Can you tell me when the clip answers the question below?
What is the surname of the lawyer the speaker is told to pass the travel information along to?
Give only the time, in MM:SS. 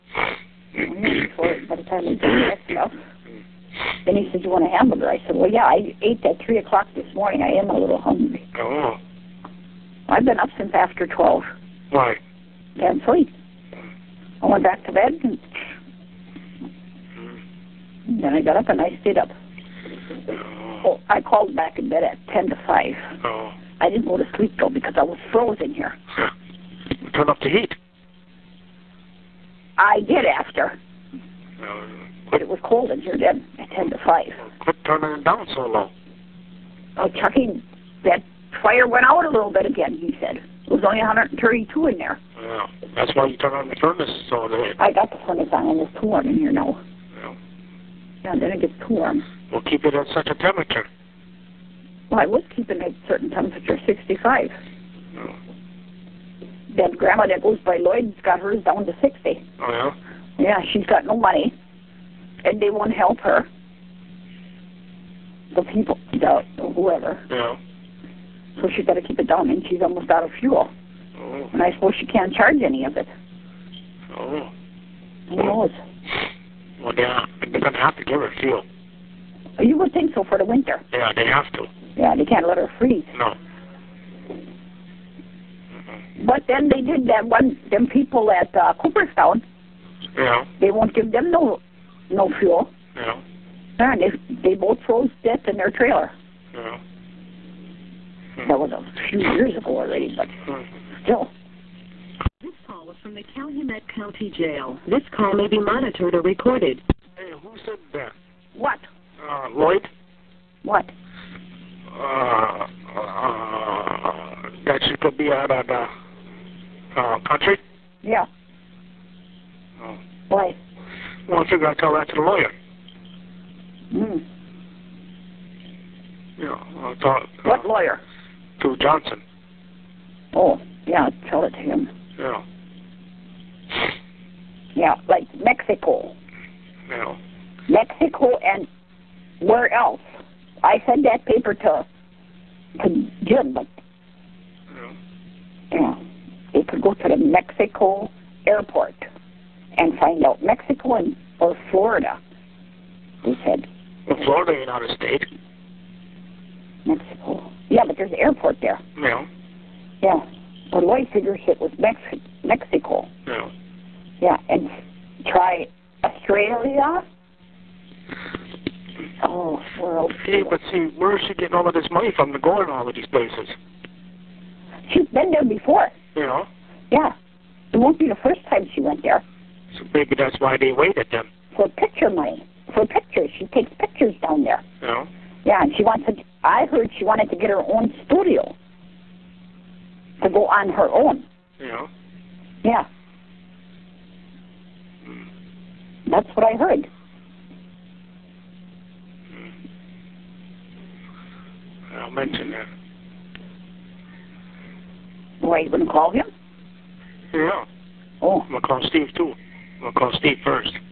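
02:08.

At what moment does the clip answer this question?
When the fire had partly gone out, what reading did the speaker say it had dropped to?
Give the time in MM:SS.
00:40.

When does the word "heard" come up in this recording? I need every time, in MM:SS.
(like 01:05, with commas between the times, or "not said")
03:06, 03:16.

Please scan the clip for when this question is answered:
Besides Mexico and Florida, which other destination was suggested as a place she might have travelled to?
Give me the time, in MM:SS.
02:46.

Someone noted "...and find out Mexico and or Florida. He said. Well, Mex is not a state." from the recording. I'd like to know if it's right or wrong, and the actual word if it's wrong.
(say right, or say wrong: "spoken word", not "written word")
wrong: "Florida", not "Mex".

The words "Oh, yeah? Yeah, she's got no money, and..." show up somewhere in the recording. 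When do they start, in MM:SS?
00:59.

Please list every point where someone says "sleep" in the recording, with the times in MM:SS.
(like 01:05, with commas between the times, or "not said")
00:13, 00:24.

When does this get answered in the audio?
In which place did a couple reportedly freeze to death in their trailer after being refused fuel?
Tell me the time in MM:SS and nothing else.
01:28.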